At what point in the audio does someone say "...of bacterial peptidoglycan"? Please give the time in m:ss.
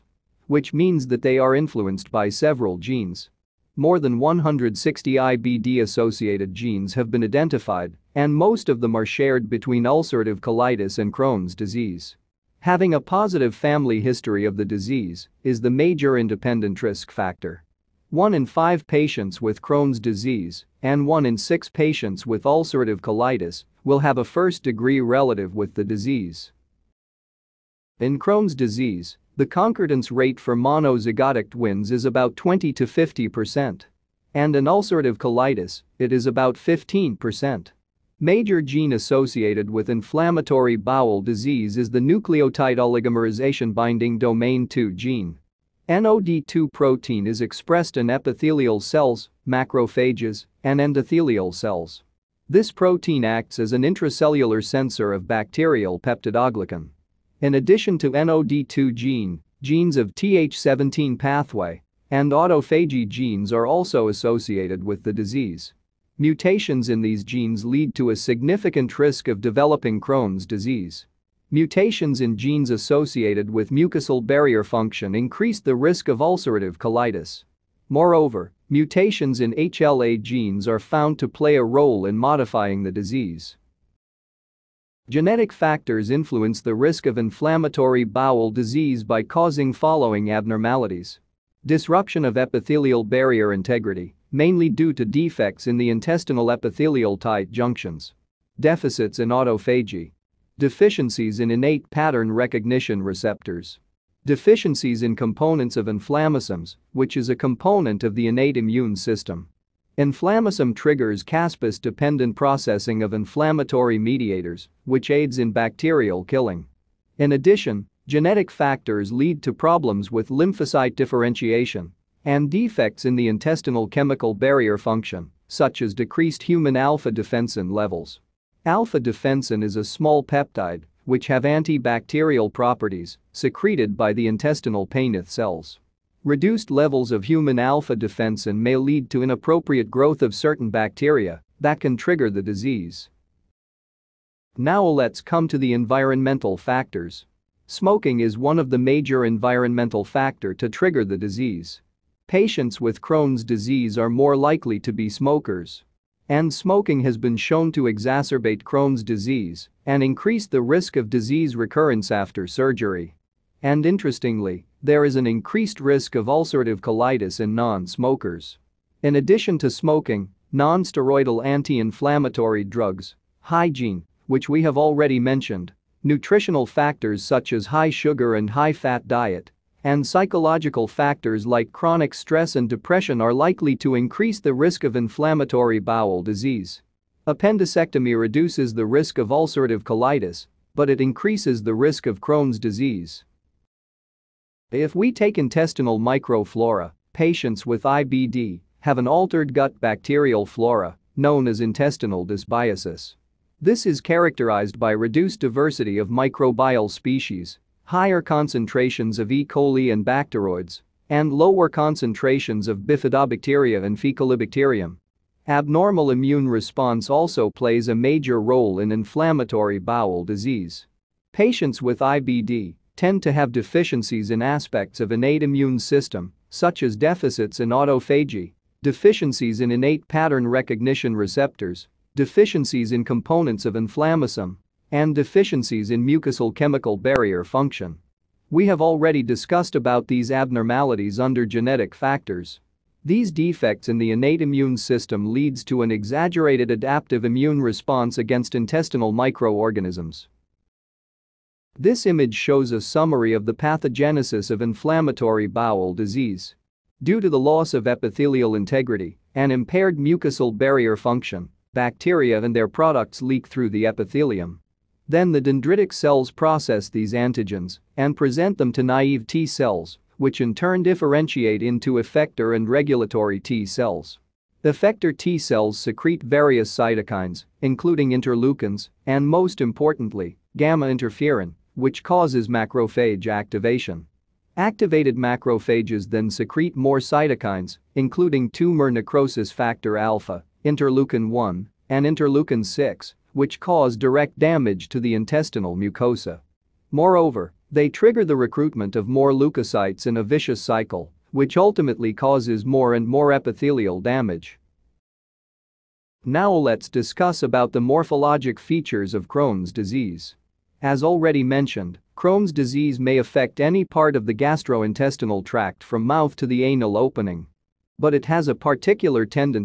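0:55.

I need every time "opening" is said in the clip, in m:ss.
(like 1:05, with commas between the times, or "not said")
5:16.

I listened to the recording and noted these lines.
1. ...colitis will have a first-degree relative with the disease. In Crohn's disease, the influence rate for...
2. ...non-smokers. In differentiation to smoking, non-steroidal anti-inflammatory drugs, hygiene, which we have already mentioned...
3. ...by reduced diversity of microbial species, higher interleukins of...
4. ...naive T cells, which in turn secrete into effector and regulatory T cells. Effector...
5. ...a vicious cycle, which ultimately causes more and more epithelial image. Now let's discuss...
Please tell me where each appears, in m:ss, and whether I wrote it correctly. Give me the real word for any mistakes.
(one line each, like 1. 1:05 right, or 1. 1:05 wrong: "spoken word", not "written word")
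1. 0:22 wrong: "concordance", not "influence"
2. 2:47 wrong: "addition", not "differentiation"
3. 3:24 wrong: "concentrations", not "interleukins"
4. 4:28 wrong: "differentiate", not "secrete"
5. 5:00 wrong: "damage", not "image".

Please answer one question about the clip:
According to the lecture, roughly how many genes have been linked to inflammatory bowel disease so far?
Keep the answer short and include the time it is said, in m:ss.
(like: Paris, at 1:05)
More than 160, at 0:03.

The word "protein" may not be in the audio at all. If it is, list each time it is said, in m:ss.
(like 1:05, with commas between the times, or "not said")
0:46, 0:52.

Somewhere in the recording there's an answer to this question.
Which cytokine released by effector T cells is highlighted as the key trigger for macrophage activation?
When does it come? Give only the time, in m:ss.
4:40.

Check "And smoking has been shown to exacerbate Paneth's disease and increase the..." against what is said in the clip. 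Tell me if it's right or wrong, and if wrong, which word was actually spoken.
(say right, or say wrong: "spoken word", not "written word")
wrong: "Crohn", not "Paneth".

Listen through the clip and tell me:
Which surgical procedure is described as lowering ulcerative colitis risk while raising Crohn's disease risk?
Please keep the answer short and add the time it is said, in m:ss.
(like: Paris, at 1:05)
Appendicectomy, at 3:07.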